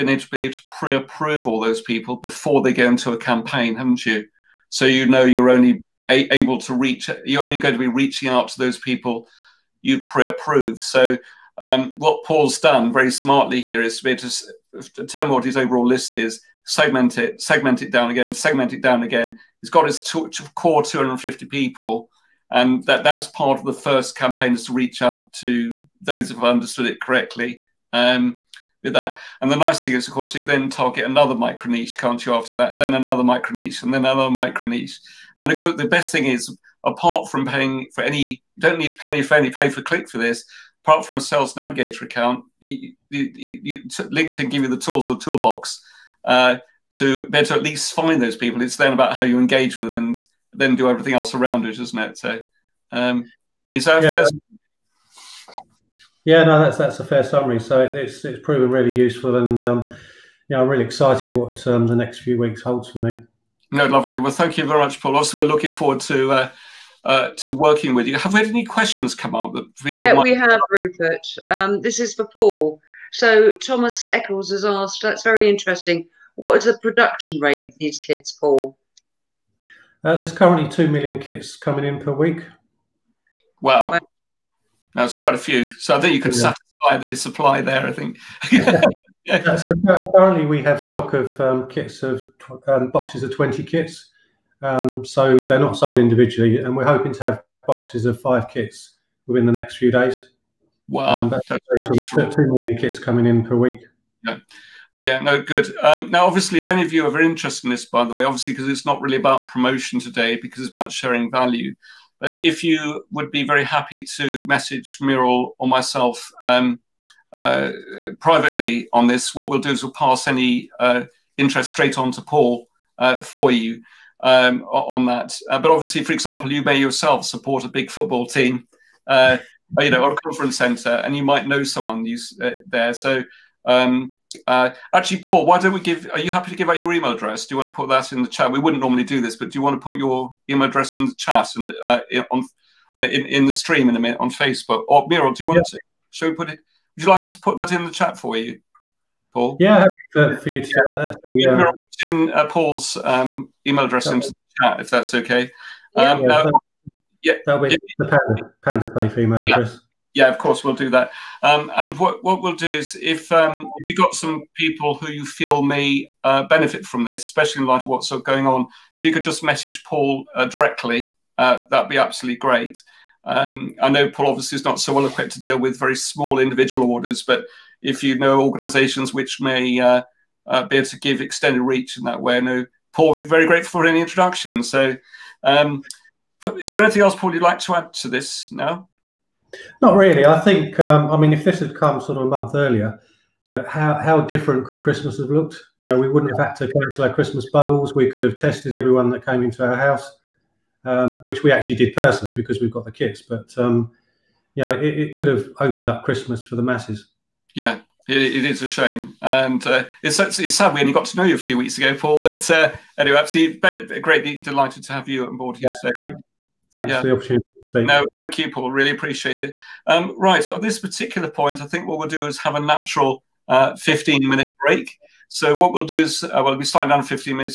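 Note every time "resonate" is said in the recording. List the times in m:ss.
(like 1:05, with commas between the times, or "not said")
not said.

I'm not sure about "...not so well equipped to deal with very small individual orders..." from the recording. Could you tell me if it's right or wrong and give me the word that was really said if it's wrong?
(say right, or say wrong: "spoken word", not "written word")
right.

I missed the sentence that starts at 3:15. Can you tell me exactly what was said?
You know, we wouldn't have had to cancel our Christmas bubbles.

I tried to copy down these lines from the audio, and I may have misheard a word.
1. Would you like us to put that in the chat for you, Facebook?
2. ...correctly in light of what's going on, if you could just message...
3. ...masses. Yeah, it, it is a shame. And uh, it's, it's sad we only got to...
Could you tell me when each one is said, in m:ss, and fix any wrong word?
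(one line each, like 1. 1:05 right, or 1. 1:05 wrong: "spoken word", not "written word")
1. 2:26 wrong: "Paul", not "Facebook"
2. 2:47 wrong: "especially", not "correctly"
3. 3:26 right.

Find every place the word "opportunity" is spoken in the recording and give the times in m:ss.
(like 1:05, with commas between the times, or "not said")
3:37.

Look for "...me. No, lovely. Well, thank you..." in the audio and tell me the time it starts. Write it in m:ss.
1:02.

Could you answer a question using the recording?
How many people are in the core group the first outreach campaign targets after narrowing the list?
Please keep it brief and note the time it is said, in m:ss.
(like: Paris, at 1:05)
250, at 0:20.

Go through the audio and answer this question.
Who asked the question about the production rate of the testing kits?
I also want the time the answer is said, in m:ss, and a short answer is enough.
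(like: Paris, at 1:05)
Thomas Eccles, at 1:13.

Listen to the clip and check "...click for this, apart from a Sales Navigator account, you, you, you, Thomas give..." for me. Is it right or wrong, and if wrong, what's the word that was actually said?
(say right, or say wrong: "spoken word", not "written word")
wrong: "LinkedIn", not "Thomas".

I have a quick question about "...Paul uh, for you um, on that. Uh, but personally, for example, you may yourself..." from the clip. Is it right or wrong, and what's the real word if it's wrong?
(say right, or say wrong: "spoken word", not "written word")
wrong: "obviously", not "personally".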